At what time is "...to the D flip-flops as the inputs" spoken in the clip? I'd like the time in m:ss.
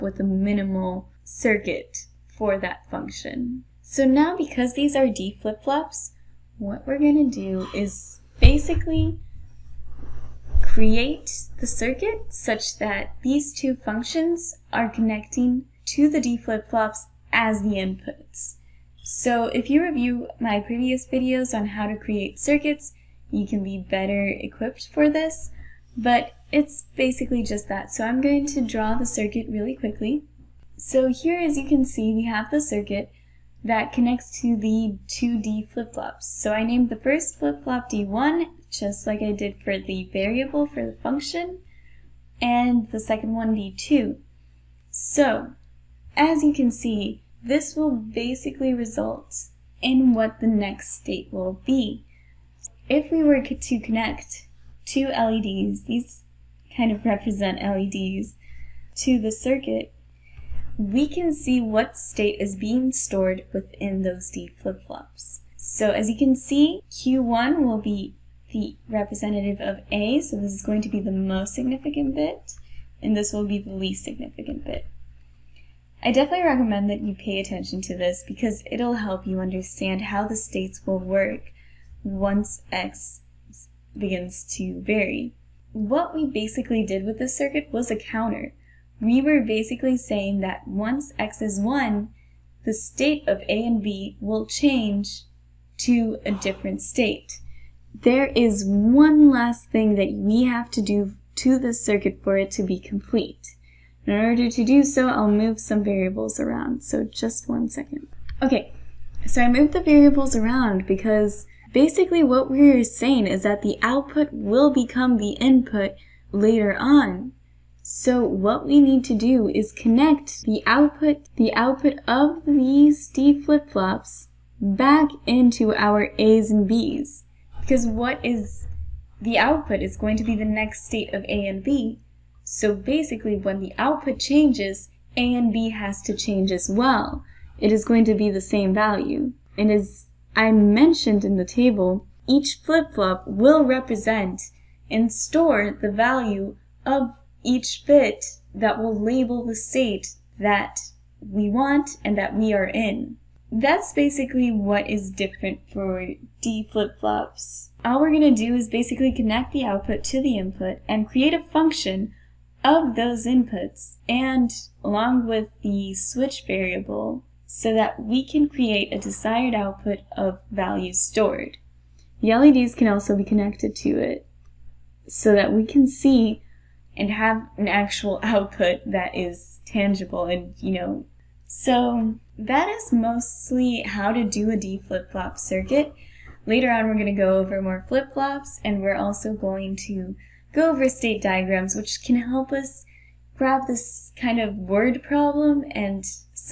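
0:15.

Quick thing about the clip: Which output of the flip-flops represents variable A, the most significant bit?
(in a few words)
Q1.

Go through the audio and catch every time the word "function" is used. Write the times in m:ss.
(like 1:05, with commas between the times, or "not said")
0:02, 0:13, 0:41, 2:41.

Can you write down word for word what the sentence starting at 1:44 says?
In order to do so, I'll move some variables around, so just one second.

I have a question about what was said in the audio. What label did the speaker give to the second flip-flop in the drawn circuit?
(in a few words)
d2.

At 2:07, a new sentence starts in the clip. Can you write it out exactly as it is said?
Because what is the output is going to be the next state of A and B.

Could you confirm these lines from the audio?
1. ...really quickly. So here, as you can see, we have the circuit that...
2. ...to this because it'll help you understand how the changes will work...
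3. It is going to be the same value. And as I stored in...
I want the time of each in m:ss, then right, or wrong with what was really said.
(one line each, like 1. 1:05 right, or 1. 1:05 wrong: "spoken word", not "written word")
1. 0:29 right
2. 1:17 wrong: "states", not "changes"
3. 2:17 wrong: "mentioned", not "stored".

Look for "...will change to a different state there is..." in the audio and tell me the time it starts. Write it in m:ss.
1:34.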